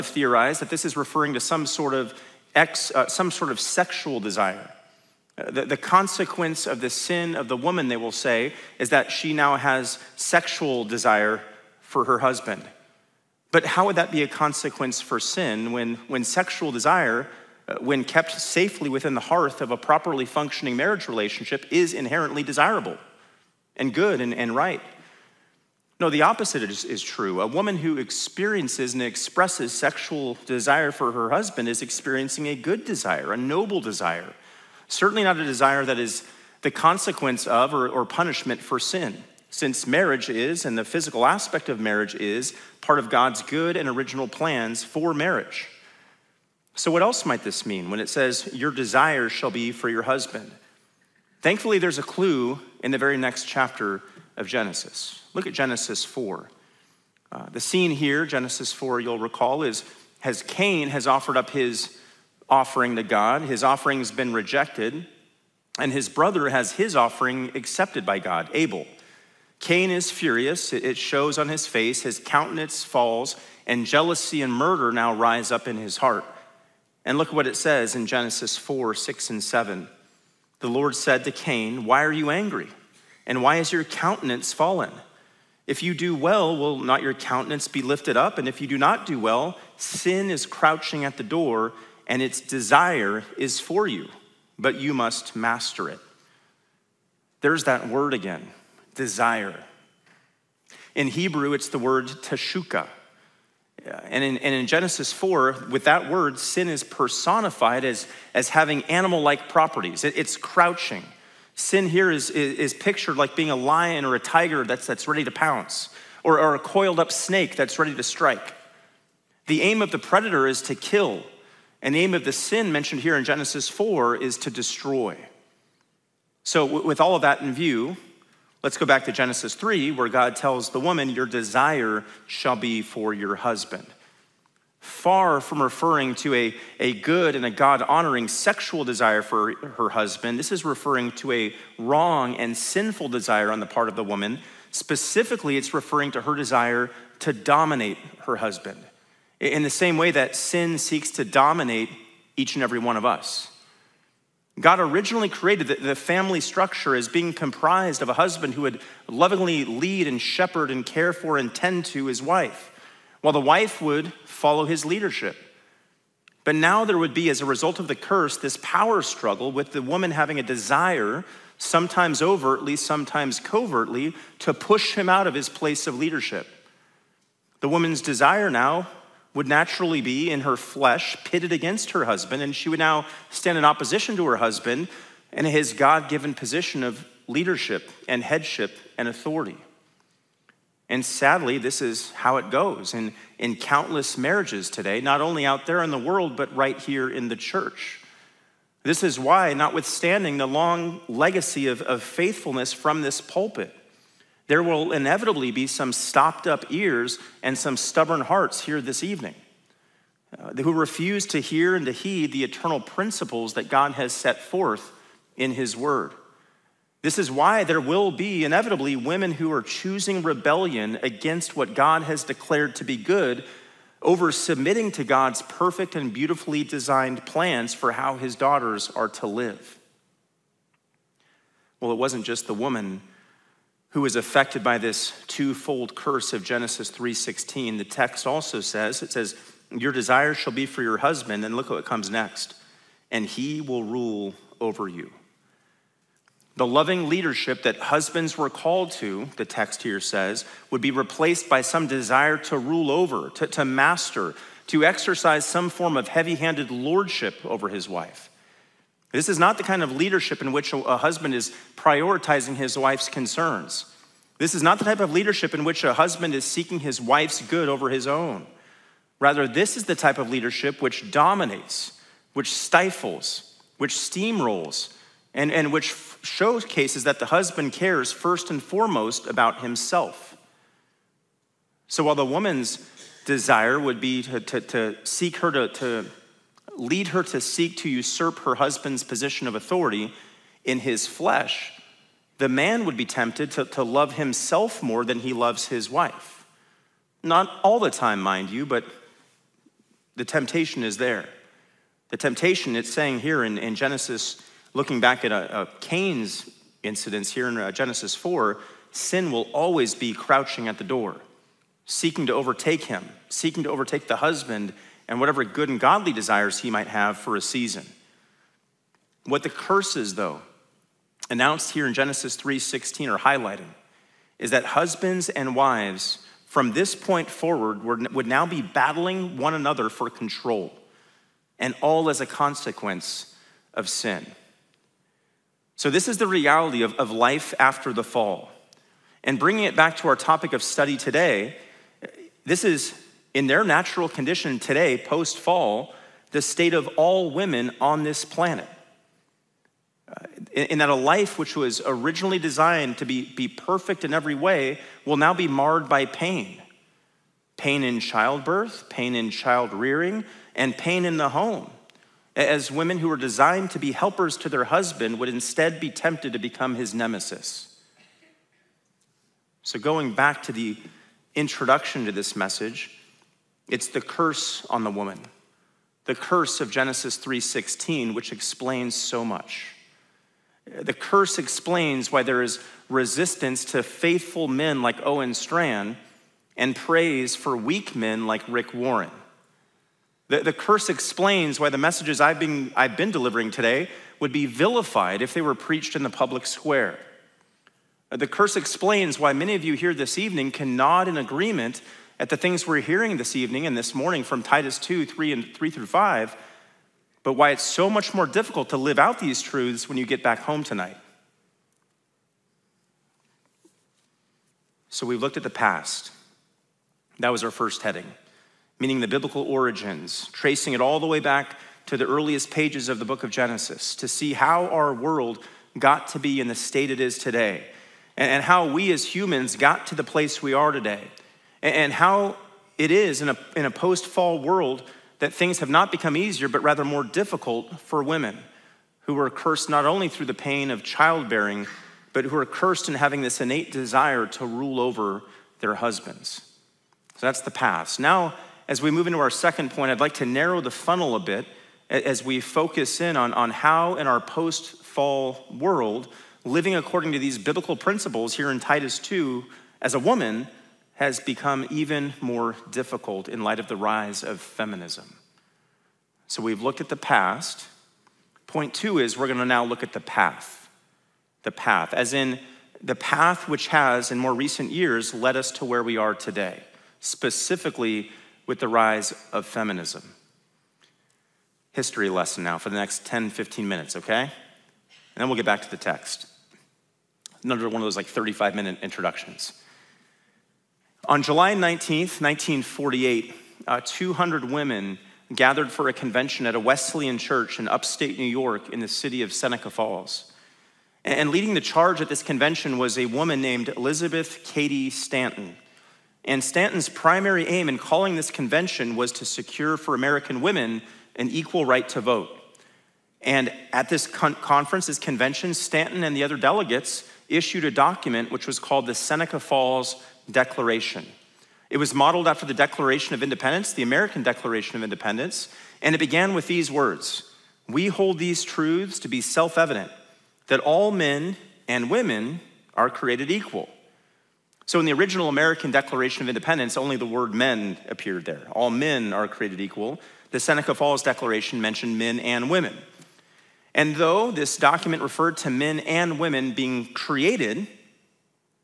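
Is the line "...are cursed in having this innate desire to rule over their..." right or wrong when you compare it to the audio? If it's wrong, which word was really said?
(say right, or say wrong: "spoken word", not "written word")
right.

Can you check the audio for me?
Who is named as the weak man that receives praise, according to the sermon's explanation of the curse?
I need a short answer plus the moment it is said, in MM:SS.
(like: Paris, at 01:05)
Rick Warren, at 06:28.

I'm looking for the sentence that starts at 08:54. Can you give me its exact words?
So, in the original American Declaration of Independence, only the word men appeared there.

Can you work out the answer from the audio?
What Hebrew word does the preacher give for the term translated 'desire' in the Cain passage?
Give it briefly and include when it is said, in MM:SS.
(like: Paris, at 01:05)
teshuka, at 01:42.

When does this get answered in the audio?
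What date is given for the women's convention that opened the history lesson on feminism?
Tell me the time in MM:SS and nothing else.
08:11.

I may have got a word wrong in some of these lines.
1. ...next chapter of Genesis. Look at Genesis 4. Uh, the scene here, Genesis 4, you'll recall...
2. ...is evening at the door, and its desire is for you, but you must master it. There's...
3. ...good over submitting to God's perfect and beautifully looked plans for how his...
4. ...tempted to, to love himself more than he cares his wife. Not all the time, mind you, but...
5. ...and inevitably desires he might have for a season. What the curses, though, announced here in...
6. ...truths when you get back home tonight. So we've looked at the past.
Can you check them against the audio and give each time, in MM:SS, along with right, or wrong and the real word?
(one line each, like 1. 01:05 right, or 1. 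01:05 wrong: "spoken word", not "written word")
1. 00:53 right
2. 01:30 wrong: "crouching", not "evening"
3. 03:42 wrong: "designed", not "looked"
4. 04:53 wrong: "loves", not "cares"
5. 05:15 wrong: "godly", not "inevitably"
6. 06:49 right.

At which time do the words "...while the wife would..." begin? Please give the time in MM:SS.
02:43.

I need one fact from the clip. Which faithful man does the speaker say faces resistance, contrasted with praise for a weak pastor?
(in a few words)
Owen Strachan.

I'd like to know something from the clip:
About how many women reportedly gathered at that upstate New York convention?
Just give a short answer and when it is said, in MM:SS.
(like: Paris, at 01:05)
200, at 08:13.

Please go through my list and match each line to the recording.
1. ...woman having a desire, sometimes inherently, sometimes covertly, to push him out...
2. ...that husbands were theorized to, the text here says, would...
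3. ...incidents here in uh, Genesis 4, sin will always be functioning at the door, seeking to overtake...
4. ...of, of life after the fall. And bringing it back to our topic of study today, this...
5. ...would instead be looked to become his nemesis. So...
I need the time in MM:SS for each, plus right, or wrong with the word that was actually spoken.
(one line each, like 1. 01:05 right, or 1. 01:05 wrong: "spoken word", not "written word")
1. 02:49 wrong: "overtly", not "inherently"
2. 04:07 wrong: "called", not "theorized"
3. 05:06 wrong: "crouching", not "functioning"
4. 05:36 right
5. 06:05 wrong: "tempted", not "looked".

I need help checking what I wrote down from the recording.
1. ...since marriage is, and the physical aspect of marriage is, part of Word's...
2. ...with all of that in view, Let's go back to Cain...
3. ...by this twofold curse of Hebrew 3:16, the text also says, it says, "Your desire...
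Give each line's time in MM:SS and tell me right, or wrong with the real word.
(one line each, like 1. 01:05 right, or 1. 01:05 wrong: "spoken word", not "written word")
1. 00:39 wrong: "God", not "Word"
2. 02:06 wrong: "Genesis", not "Cain"
3. 03:54 wrong: "Genesis", not "Hebrew".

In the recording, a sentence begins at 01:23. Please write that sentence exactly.
And why is your countenance fallen?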